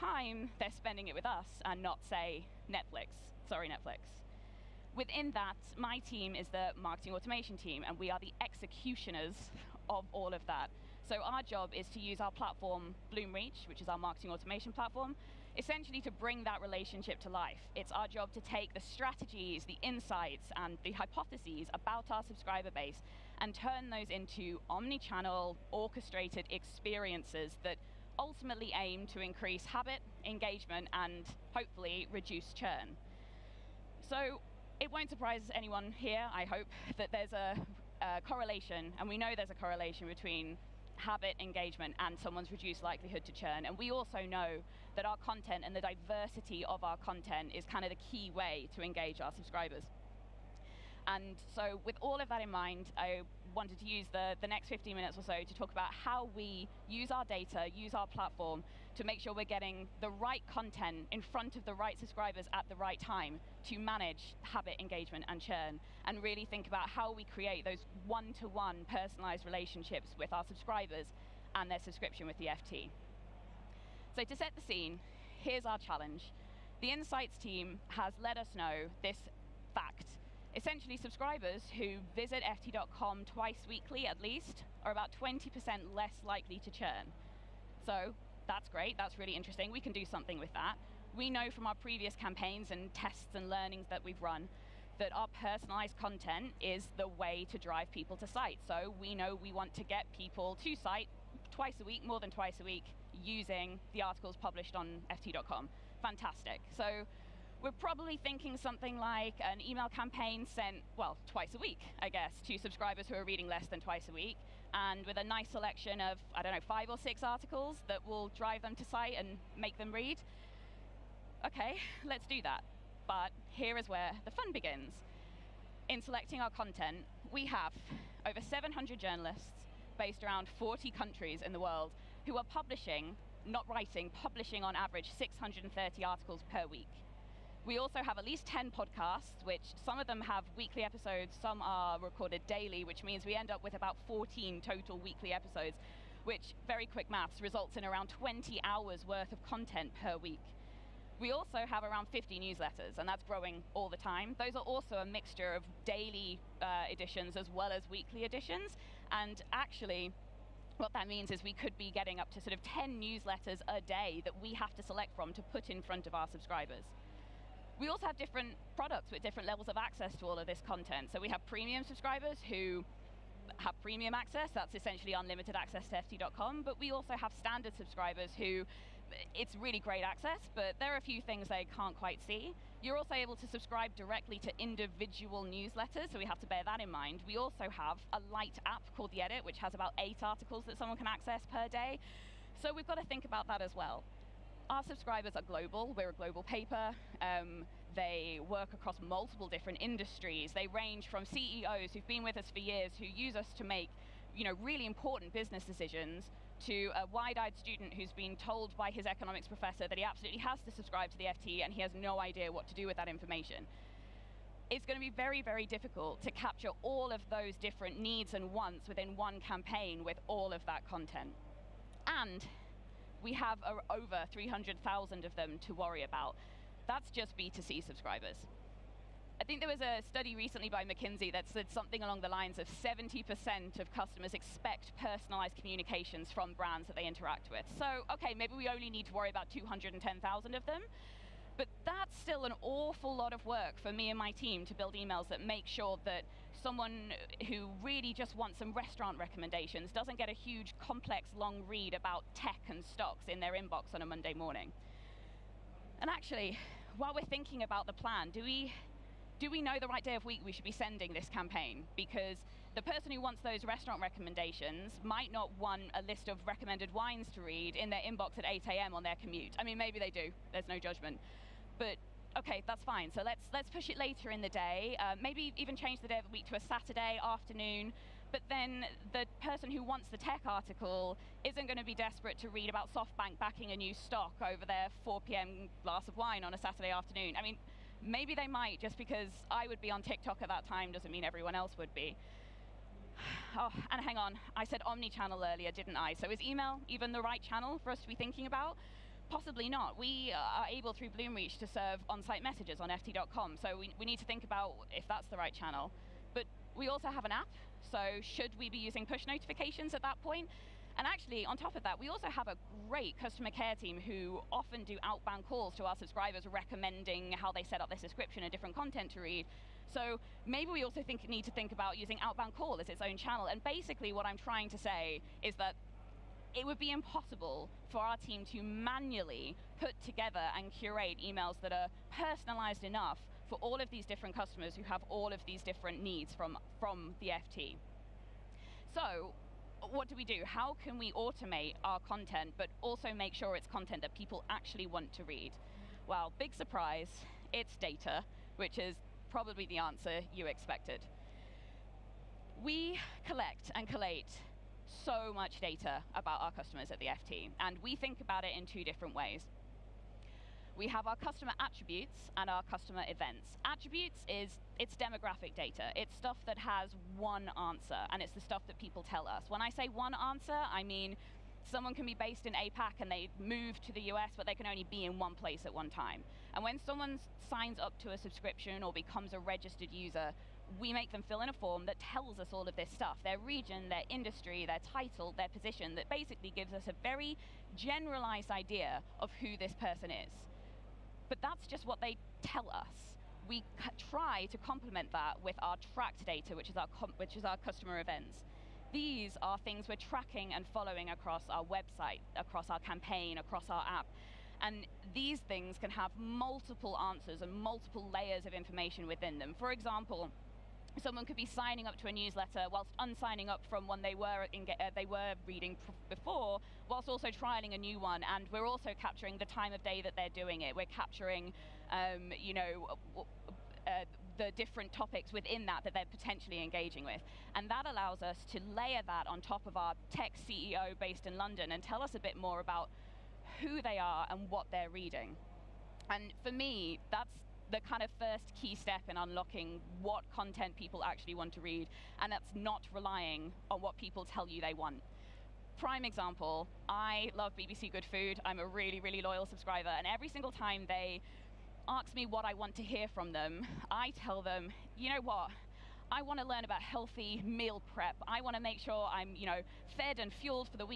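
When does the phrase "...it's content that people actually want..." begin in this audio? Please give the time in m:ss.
5:43.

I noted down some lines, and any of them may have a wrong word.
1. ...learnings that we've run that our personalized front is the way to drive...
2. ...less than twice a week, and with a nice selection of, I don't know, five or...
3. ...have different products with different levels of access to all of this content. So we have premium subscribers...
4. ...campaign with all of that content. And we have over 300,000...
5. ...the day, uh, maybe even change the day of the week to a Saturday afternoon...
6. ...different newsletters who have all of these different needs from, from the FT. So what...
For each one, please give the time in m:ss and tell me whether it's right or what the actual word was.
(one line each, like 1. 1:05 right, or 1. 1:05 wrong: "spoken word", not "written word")
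1. 1:33 wrong: "content", not "front"
2. 1:53 right
3. 2:48 right
4. 3:39 right
5. 4:34 right
6. 5:34 wrong: "customers", not "newsletters".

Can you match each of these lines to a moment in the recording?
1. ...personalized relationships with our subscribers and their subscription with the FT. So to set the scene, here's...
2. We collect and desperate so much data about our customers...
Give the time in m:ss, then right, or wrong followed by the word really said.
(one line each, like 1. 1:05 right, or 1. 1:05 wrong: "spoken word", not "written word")
1. 1:08 right
2. 5:52 wrong: "collate", not "desperate".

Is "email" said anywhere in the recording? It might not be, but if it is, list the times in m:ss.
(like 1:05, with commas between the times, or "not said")
1:49, 4:04, 4:56, 5:31.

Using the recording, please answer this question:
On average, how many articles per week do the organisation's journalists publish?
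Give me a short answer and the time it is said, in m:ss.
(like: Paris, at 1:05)
630, at 2:15.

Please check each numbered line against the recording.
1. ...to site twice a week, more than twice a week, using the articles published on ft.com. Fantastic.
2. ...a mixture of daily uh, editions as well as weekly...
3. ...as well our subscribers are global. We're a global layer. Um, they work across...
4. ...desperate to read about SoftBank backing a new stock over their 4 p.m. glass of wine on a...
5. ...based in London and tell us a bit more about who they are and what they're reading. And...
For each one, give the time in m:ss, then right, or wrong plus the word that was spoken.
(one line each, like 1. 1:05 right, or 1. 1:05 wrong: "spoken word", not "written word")
1. 1:40 right
2. 2:34 right
3. 3:13 wrong: "paper", not "layer"
4. 4:41 right
5. 7:10 right.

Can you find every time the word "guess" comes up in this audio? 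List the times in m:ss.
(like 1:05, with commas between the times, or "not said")
1:52.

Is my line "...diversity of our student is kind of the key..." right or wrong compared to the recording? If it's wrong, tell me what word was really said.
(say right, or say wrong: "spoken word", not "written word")
wrong: "content", not "student".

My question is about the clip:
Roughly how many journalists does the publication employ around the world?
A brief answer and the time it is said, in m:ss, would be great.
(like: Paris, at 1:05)
700, at 2:08.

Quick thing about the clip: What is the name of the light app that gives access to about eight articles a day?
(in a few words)
The Edit.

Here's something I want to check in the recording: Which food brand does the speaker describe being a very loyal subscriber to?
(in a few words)
BBC Good Food.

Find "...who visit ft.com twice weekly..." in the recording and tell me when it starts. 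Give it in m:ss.
1:21.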